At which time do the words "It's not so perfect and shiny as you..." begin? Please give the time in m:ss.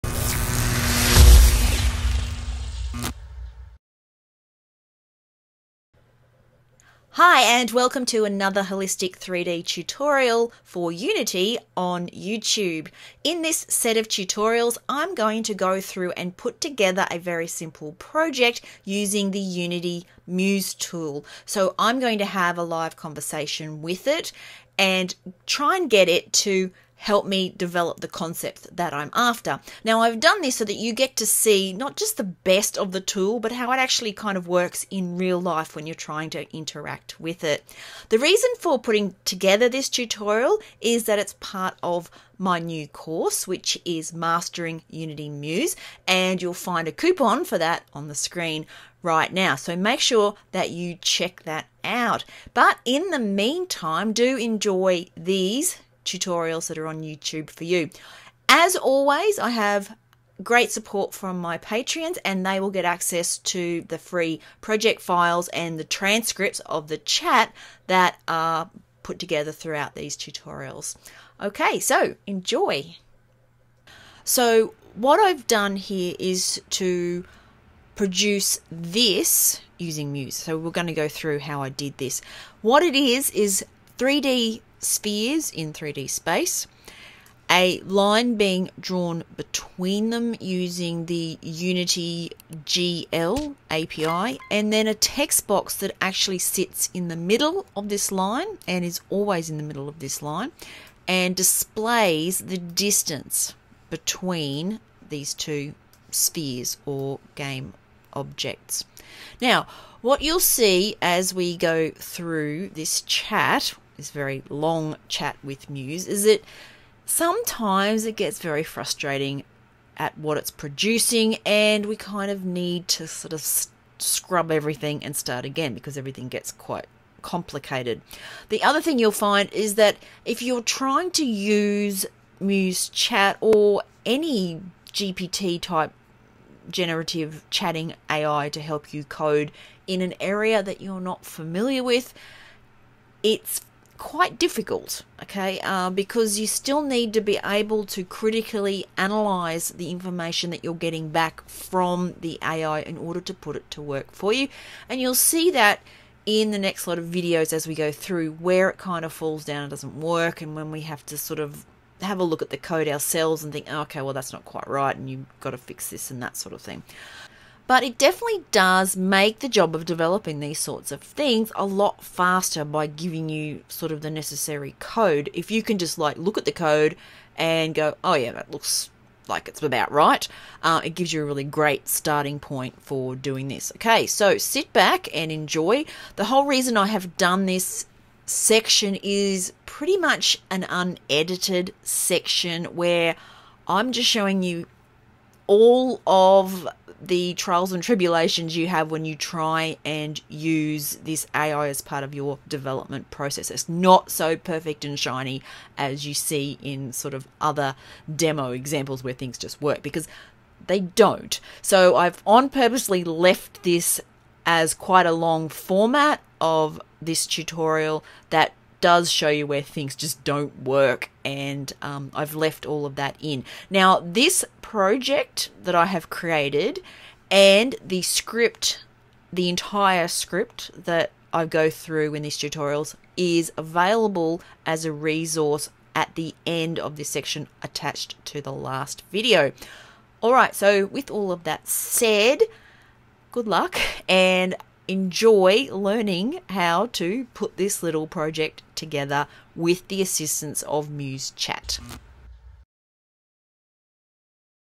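3:23.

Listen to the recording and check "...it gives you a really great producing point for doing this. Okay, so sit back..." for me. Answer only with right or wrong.
wrong.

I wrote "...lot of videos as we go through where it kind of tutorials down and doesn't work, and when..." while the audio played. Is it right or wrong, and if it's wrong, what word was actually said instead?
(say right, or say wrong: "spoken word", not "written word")
wrong: "falls", not "tutorials".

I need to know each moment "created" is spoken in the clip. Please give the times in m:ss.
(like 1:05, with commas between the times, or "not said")
3:46.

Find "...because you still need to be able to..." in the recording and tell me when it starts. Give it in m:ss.
2:25.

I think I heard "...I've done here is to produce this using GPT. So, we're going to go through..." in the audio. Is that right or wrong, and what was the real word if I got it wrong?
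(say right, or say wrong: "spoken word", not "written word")
wrong: "Muse", not "GPT".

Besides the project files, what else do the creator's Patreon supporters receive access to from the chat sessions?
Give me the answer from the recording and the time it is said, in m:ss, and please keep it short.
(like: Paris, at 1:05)
transcripts, at 1:05.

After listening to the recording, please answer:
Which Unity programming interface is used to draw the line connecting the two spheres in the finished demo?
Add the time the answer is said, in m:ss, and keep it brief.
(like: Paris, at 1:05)
GL API, at 1:32.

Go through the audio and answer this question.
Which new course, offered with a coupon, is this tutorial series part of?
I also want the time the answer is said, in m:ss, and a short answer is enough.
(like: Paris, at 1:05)
Mastering Unity Muse, at 0:44.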